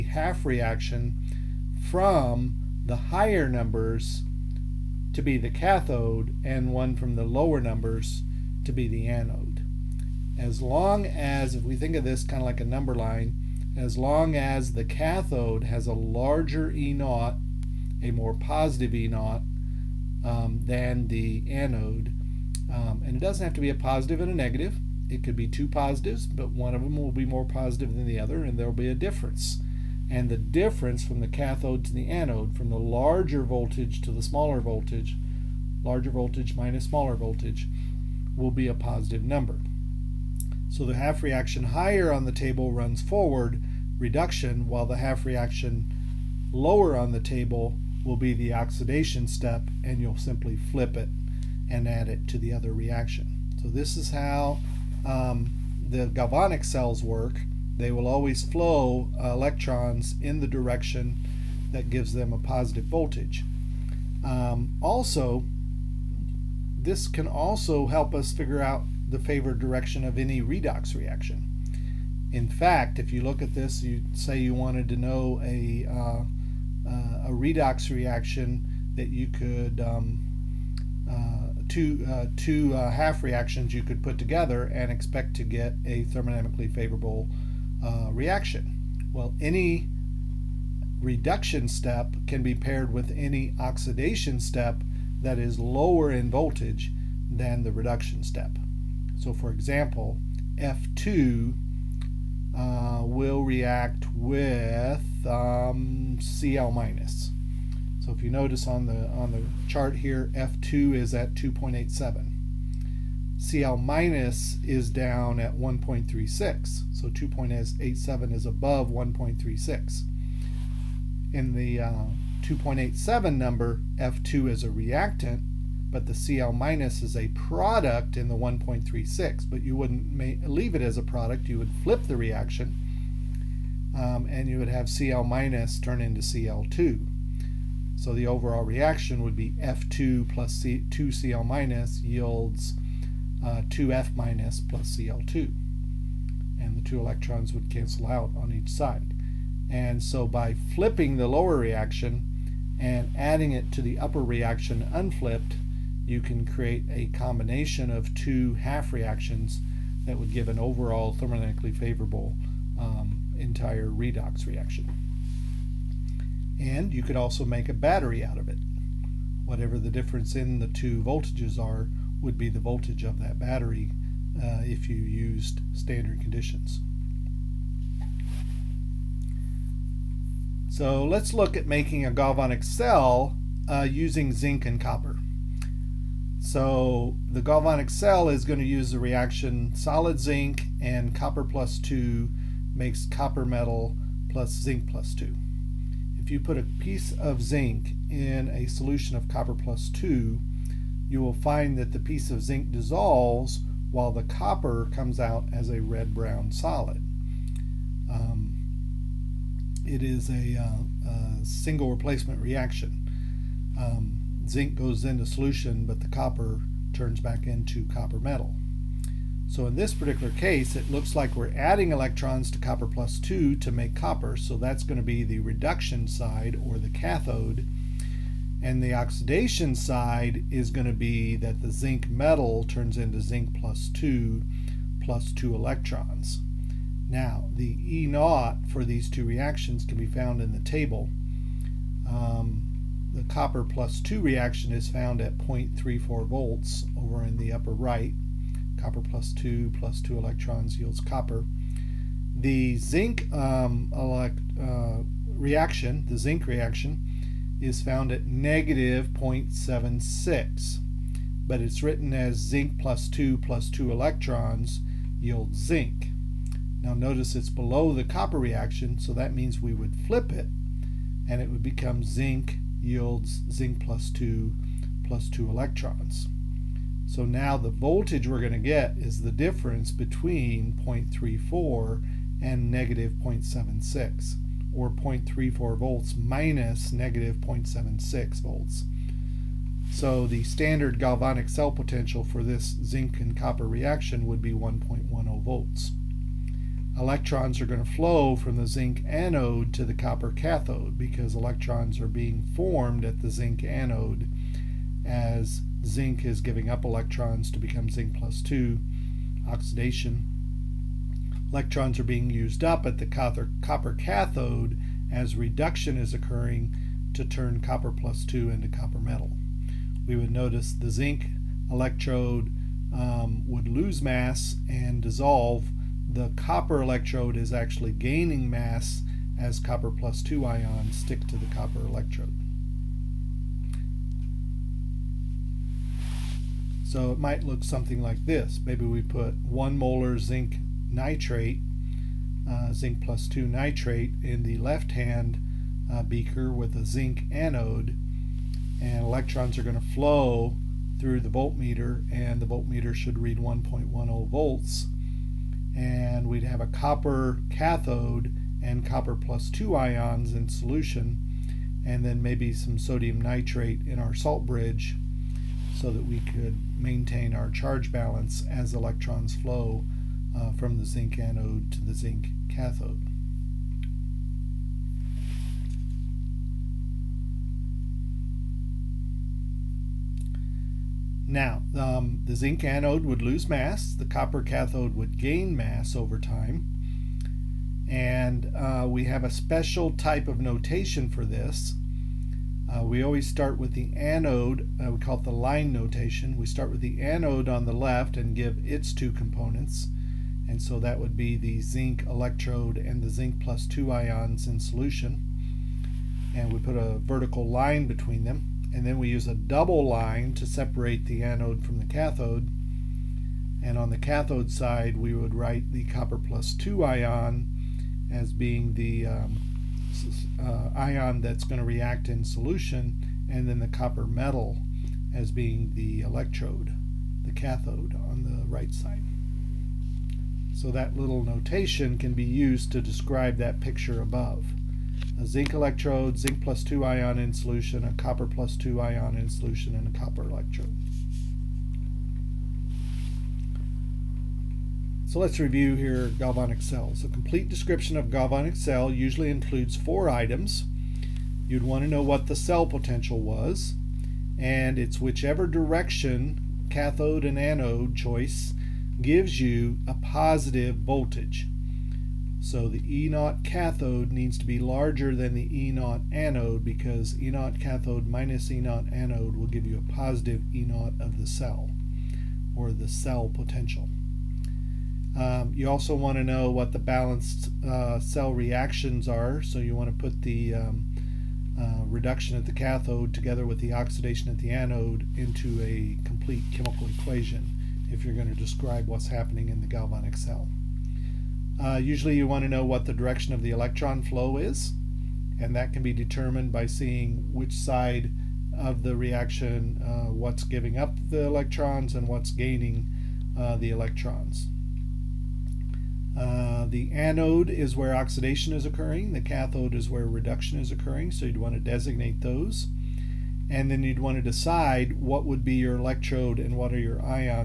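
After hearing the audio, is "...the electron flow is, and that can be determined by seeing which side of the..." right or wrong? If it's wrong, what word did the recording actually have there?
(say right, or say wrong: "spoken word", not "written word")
right.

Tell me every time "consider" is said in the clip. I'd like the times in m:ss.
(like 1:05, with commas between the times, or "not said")
not said.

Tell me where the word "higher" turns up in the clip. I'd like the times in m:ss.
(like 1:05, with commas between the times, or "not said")
0:02, 0:41.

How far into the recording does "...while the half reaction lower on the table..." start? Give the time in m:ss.
0:44.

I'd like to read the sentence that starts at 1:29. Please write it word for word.
Well, any reduction step can be paired with any oxidation step that is lower in voltage than the reduction step.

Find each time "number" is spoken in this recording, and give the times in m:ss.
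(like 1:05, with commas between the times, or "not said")
0:03, 0:07, 0:12, 0:39, 2:03.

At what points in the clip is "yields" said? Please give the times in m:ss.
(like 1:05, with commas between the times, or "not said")
2:22, 4:10, 4:25, 4:32.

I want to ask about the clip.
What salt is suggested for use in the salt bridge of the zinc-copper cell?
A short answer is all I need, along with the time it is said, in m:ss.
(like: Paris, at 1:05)
sodium nitrate, at 6:02.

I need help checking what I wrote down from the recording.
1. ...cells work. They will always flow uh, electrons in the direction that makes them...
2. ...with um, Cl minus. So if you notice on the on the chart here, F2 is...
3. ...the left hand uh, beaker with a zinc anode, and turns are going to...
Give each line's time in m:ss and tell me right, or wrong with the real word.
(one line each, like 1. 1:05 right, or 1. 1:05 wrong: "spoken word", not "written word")
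1. 0:56 wrong: "gives", not "makes"
2. 1:44 right
3. 5:44 wrong: "electrons", not "turns".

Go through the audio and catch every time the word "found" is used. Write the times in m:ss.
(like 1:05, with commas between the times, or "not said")
4:00, 4:04, 4:17.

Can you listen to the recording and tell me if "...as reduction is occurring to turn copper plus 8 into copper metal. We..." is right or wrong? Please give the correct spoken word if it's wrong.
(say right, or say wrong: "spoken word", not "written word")
wrong: "2", not "8".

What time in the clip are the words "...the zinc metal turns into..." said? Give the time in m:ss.
3:51.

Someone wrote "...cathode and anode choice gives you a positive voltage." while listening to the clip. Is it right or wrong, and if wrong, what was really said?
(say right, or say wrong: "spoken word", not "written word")
right.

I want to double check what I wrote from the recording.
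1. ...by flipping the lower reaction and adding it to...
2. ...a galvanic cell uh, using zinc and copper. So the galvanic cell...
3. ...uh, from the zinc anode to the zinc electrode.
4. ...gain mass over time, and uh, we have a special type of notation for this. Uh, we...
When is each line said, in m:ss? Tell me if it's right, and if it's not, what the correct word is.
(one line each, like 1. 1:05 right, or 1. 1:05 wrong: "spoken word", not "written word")
1. 2:30 right
2. 3:02 right
3. 6:10 wrong: "cathode", not "electrode"
4. 6:25 right.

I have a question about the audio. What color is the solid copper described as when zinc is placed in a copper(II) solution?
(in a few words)
red-brown.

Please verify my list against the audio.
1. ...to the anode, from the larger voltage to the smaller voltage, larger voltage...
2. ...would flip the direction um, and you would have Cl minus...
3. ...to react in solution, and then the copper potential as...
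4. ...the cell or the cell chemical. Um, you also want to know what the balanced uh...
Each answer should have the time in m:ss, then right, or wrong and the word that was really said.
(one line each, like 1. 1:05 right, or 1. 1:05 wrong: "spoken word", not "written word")
1. 0:31 right
2. 2:11 wrong: "reaction", not "direction"
3. 7:01 wrong: "metal", not "potential"
4. 7:51 wrong: "potential", not "chemical".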